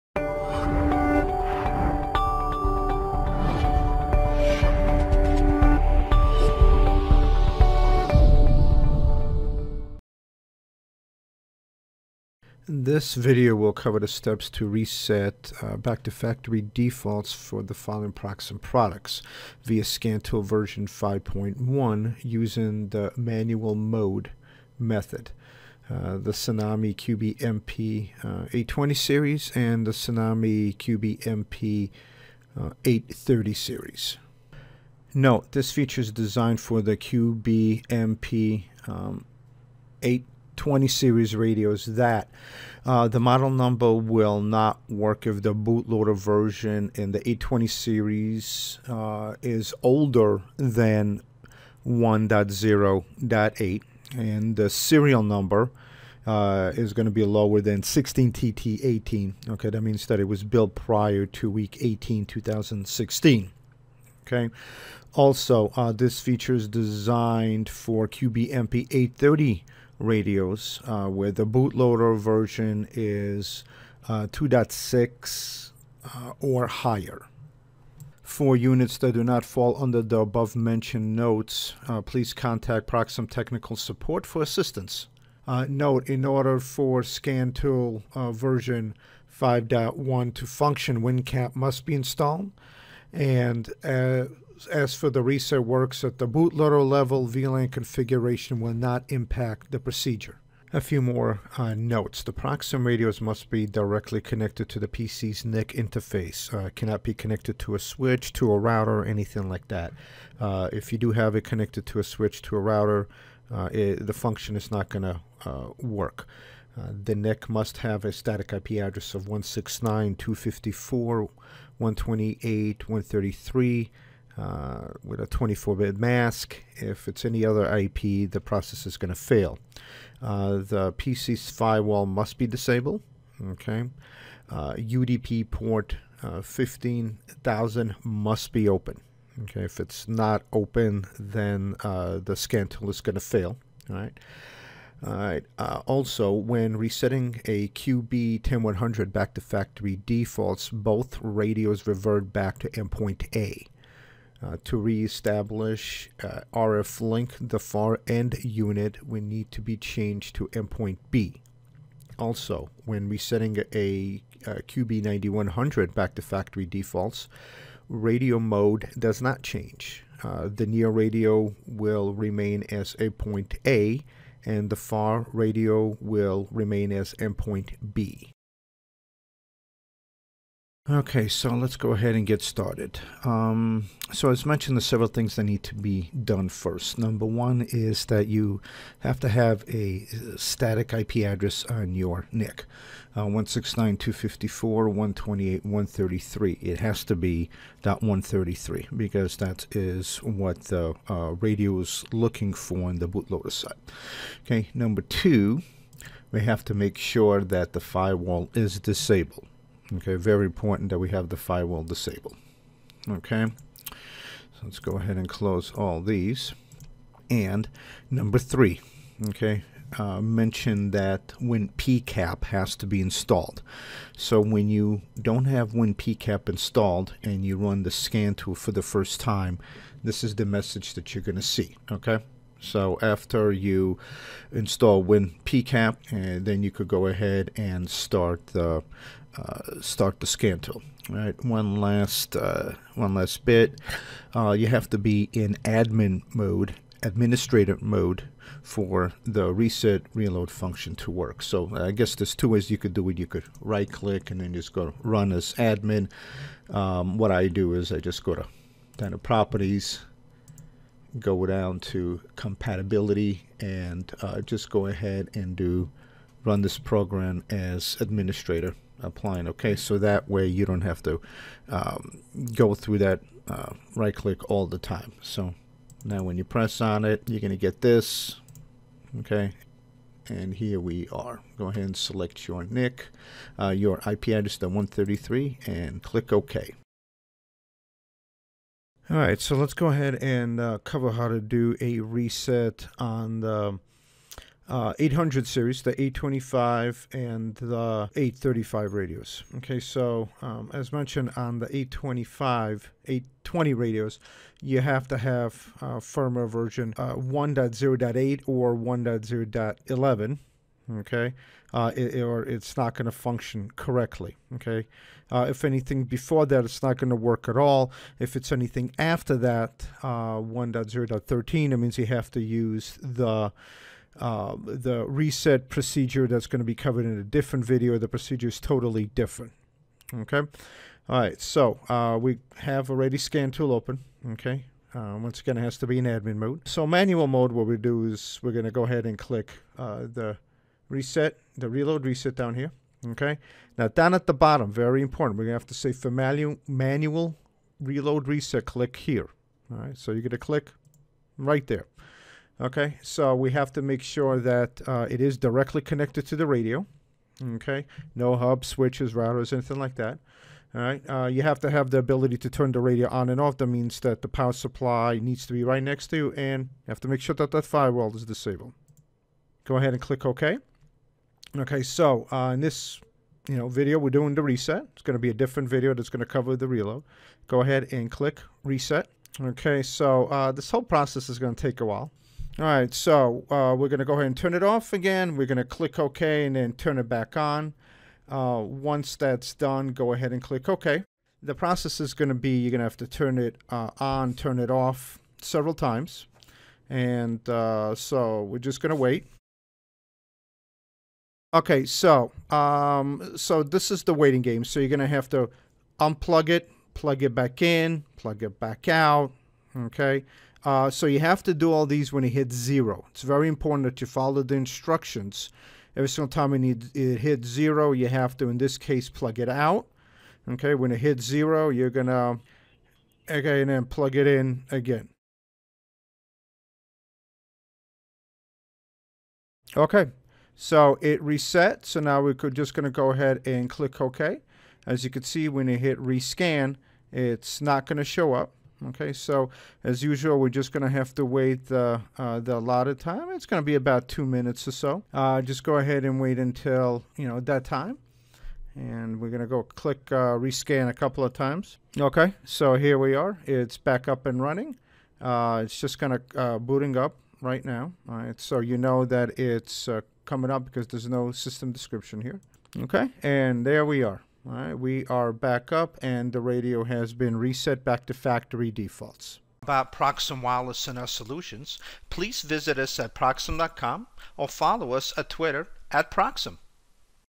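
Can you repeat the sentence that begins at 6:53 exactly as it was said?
It's very important that you follow the instructions.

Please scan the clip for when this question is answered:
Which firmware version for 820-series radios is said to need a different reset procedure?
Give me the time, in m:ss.
5:20.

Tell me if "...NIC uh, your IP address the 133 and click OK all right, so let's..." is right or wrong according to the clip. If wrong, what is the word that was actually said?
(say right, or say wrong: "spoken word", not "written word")
right.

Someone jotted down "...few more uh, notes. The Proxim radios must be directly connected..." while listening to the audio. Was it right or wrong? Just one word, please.
right.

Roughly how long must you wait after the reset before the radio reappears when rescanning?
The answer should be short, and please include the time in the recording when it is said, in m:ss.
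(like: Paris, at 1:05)
about two minutes, at 7:23.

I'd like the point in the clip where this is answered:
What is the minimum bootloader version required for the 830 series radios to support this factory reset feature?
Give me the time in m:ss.
1:14.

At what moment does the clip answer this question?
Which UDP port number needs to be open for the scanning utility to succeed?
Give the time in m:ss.
2:16.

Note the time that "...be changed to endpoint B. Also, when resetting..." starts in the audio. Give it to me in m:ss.
2:39.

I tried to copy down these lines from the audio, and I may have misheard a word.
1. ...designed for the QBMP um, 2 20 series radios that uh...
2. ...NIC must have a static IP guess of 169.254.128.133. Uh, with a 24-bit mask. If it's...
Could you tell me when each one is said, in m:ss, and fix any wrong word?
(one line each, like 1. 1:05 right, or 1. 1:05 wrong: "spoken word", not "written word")
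1. 0:36 wrong: "8", not "2"
2. 1:57 wrong: "address", not "guess".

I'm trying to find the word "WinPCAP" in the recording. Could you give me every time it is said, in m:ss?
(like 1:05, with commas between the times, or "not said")
1:31, 3:41, 3:45, 3:55.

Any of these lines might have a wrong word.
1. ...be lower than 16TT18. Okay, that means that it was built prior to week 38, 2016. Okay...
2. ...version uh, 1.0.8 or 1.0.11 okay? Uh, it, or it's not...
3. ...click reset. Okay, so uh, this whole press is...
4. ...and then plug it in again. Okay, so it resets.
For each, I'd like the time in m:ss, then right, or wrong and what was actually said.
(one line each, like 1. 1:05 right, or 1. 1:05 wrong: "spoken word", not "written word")
1. 0:57 wrong: "18", not "38"
2. 5:06 right
3. 6:18 wrong: "process", not "press"
4. 7:03 right.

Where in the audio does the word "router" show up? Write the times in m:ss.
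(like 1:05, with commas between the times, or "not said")
1:48, 1:52, 5:59.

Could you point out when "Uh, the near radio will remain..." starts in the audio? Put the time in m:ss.
2:50.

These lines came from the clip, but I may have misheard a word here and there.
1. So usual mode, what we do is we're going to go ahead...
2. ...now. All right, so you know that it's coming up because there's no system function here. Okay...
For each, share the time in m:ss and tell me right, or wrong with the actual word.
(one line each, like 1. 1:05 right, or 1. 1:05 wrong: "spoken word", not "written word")
1. 5:36 wrong: "manual", not "usual"
2. 7:37 wrong: "description", not "function".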